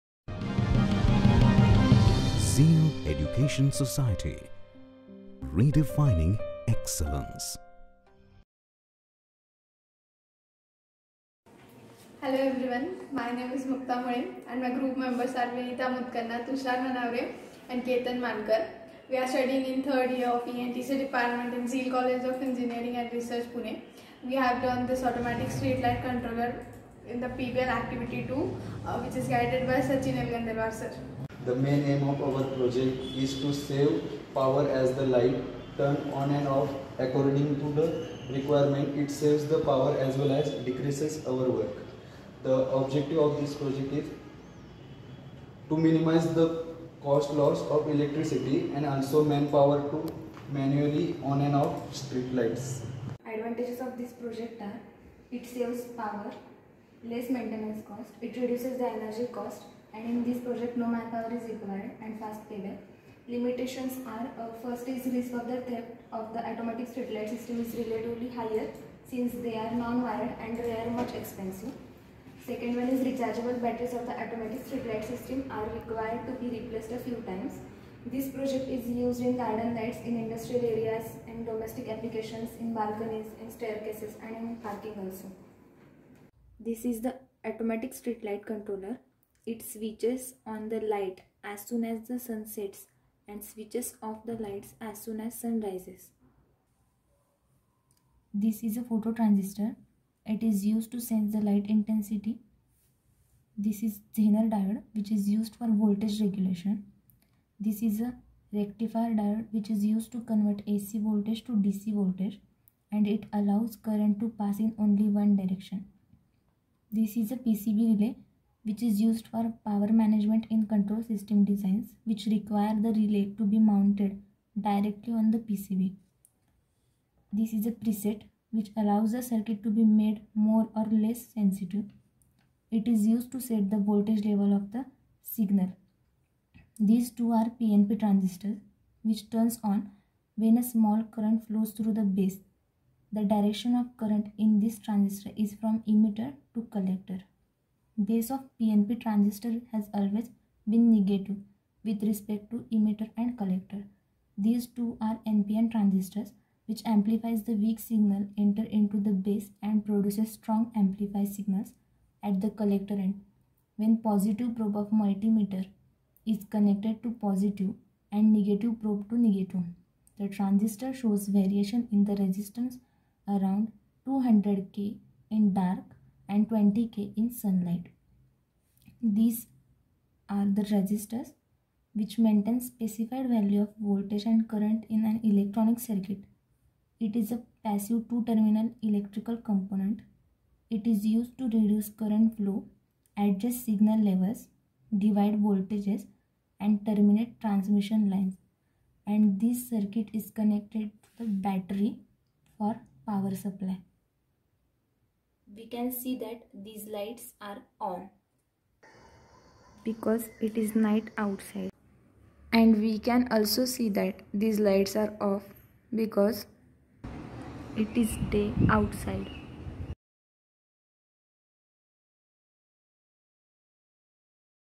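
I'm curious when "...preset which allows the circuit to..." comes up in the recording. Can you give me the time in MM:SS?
02:07.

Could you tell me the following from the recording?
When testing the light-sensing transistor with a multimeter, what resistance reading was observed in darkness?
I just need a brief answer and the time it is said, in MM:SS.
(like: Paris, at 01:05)
200K, at 02:54.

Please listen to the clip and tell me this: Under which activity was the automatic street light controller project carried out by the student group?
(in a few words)
PBL activity 2.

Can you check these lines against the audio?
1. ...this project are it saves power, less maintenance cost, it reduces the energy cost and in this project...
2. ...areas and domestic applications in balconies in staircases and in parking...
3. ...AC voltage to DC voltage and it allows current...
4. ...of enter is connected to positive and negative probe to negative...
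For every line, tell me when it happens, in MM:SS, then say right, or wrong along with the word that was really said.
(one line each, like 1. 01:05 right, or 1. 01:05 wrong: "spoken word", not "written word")
1. 00:53 right
2. 01:20 right
3. 01:50 right
4. 02:44 wrong: "multimeter", not "enter".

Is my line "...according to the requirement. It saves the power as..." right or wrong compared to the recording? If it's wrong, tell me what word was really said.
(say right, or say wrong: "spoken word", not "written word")
right.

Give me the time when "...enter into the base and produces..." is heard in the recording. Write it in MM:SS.
02:38.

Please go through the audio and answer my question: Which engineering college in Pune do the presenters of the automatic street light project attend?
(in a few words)
Zeal College of Engineering and Research.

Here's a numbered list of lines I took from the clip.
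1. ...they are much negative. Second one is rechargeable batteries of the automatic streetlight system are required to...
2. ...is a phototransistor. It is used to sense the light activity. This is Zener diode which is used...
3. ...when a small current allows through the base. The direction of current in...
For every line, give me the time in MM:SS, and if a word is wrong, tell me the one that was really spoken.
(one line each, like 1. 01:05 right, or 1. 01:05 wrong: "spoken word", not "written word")
1. 01:10 wrong: "expensive", not "negative"
2. 01:38 wrong: "intensity", not "activity"
3. 02:20 wrong: "flows", not "allows".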